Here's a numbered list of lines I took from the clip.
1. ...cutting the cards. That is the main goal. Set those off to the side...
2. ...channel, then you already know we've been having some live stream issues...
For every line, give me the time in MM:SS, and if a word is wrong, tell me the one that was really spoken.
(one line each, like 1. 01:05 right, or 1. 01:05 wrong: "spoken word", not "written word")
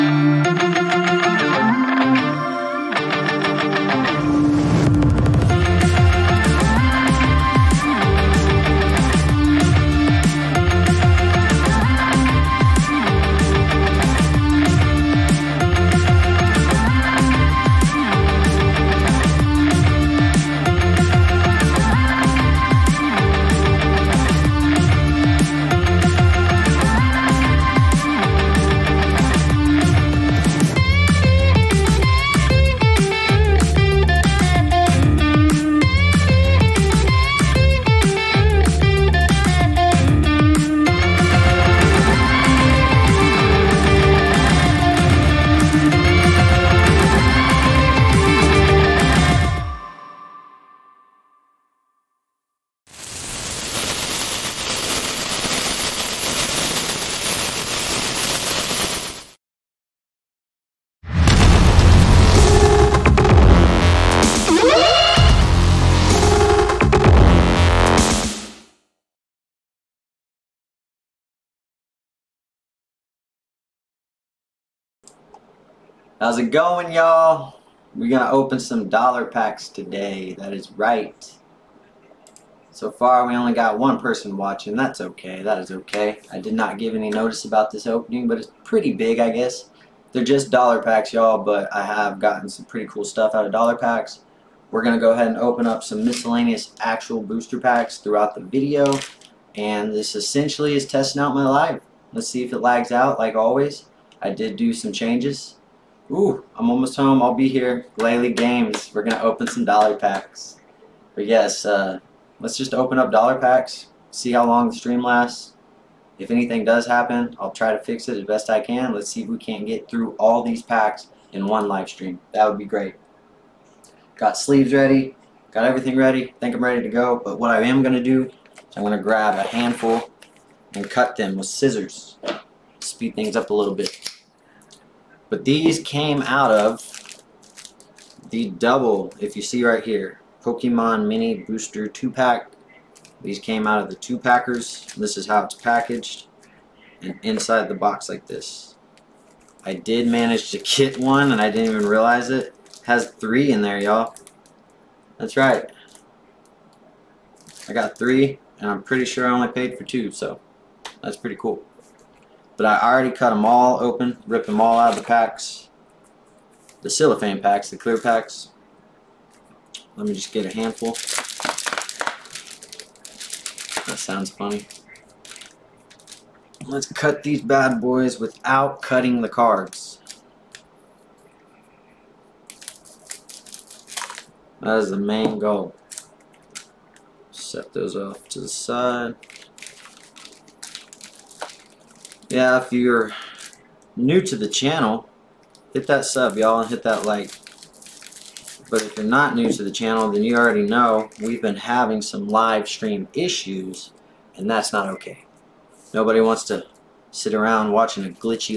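1. 02:58 right
2. 03:19 right.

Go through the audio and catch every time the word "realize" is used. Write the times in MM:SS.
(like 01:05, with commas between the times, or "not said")
02:31.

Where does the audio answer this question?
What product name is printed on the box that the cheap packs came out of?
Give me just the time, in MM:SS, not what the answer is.
02:20.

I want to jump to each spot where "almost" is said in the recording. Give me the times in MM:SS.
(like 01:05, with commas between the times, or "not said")
01:46.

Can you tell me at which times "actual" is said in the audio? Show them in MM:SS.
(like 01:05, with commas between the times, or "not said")
01:36.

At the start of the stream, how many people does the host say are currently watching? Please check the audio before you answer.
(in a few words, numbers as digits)
1.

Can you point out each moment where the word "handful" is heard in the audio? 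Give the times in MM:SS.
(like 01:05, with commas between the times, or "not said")
02:09, 02:50.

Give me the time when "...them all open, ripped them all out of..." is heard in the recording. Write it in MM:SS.
02:43.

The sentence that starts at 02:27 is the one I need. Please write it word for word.
And inside the box like this.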